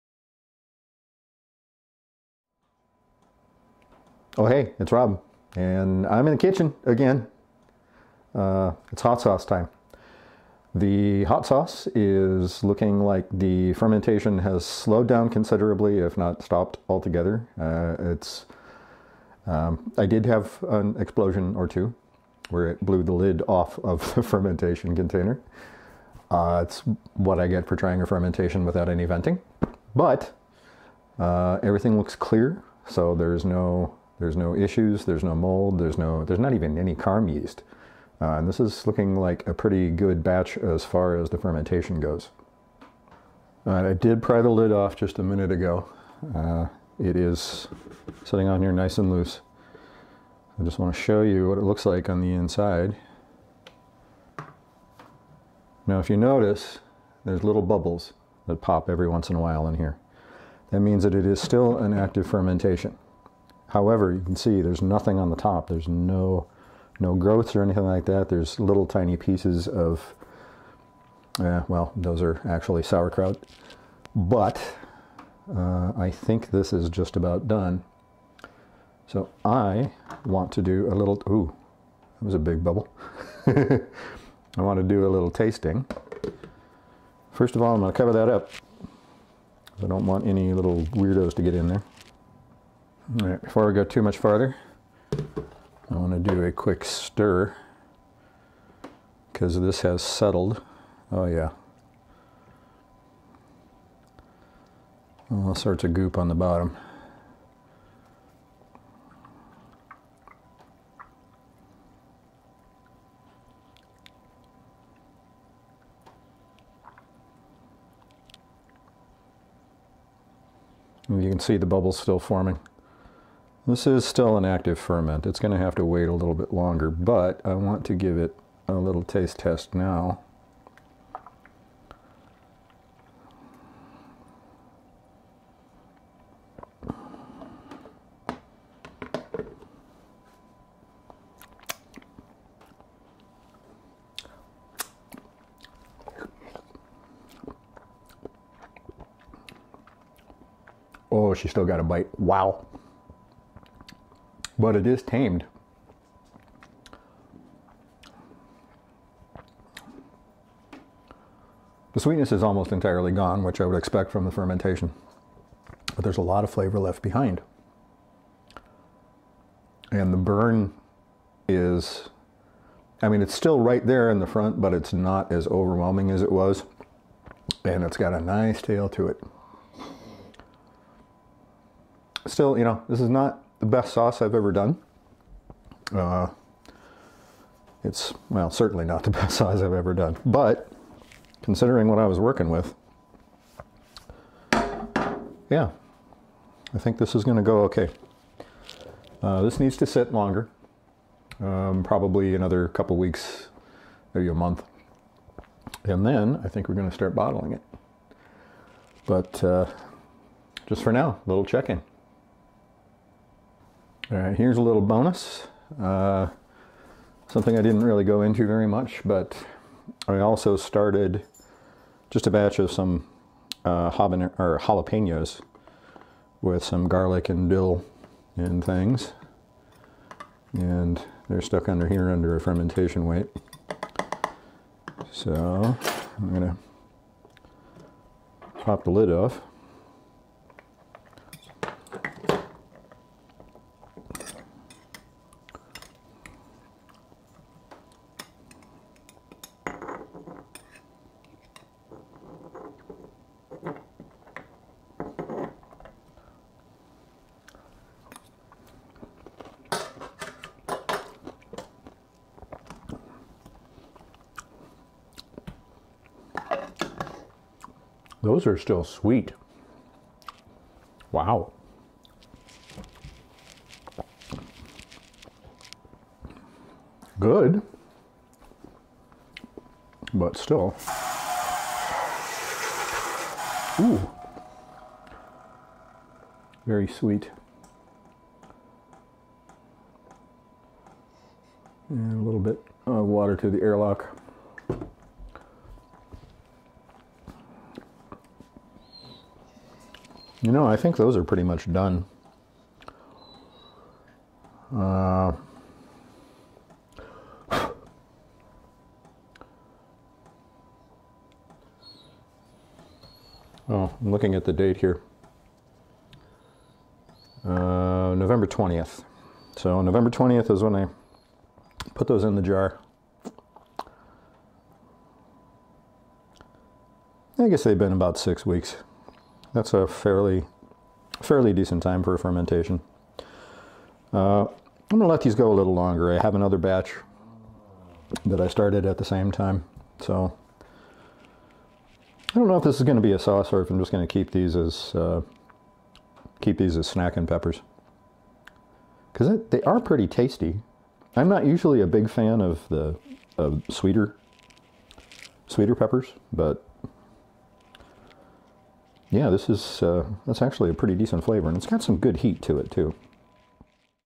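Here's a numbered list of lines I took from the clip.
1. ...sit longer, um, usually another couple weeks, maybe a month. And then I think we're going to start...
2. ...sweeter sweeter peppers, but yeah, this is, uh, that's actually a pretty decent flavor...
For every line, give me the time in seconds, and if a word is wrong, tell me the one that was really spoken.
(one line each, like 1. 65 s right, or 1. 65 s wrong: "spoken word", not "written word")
1. 199 s wrong: "probably", not "usually"
2. 353 s right.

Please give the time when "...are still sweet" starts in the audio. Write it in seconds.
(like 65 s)
268 s.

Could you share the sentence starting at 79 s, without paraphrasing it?
So I want to do a little, ooh, that was a big bubble.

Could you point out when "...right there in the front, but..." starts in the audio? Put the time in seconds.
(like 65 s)
173 s.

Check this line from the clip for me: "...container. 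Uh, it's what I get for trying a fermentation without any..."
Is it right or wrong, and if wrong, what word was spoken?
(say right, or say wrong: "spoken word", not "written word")
right.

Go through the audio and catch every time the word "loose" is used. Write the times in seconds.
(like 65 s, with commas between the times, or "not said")
49 s.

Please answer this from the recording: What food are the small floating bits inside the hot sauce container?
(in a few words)
sauerkraut.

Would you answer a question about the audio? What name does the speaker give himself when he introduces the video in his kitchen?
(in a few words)
Rob.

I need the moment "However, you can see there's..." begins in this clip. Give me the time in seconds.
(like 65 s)
63 s.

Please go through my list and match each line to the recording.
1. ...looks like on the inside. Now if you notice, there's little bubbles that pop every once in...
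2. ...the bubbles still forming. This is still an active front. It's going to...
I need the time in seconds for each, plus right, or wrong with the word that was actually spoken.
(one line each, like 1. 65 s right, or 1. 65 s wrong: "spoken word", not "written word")
1. 51 s right
2. 121 s wrong: "ferment", not "front".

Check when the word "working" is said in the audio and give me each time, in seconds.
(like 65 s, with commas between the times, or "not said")
192 s.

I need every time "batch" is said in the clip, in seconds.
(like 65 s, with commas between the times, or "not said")
40 s, 222 s, 336 s.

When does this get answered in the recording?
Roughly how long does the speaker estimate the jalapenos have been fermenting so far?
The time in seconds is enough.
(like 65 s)
327 s.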